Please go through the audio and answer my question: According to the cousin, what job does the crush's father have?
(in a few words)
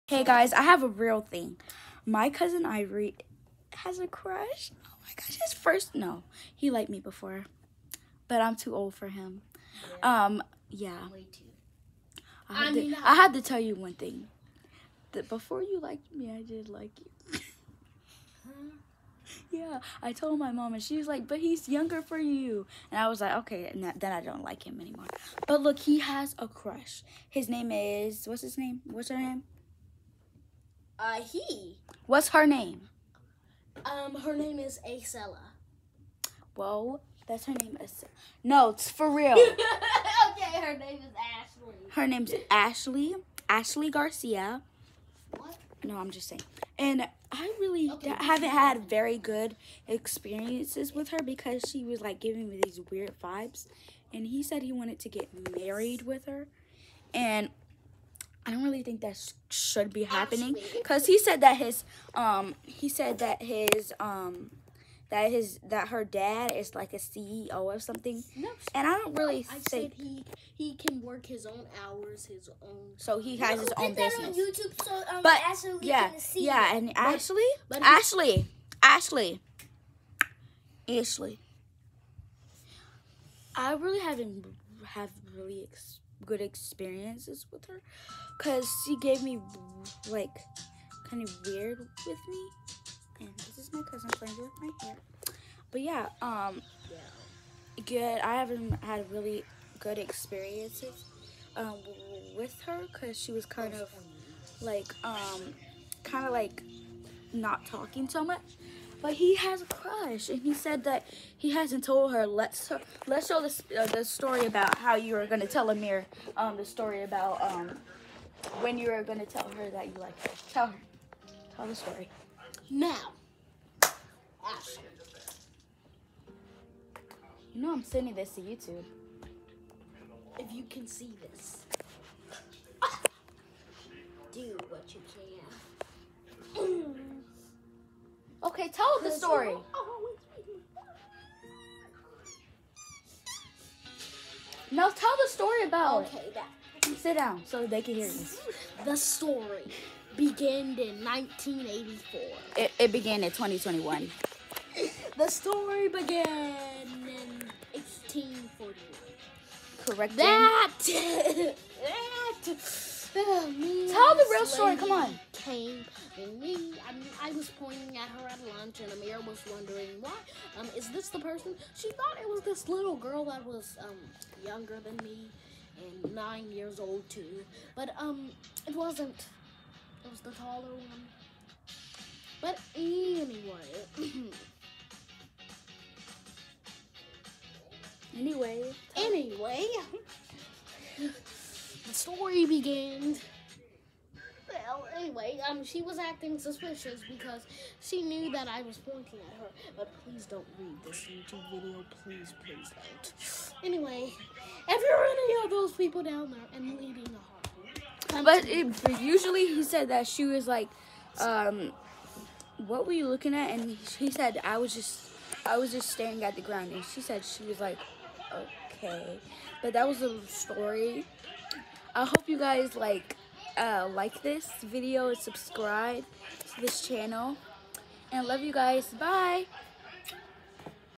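CEO.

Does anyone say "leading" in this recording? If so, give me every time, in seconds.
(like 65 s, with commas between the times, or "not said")
206 s.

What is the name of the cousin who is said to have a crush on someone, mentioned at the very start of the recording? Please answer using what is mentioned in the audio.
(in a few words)
Ivory.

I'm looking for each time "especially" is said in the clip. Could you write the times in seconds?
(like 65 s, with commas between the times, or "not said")
not said.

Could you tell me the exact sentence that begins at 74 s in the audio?
YouTube, so, um, but Ashley yeah, yeah, and Ashley, but, Ashley, but Ashley, Ashley, Ashley.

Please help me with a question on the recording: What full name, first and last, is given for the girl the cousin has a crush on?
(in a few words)
Ashley Garcia.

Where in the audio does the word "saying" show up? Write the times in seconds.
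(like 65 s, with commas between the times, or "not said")
46 s.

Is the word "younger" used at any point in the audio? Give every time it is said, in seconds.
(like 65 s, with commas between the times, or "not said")
21 s, 174 s.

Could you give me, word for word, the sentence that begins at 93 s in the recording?
And this is my cousin playing with my hair.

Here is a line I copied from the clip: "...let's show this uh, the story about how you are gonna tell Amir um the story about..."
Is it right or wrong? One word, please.
right.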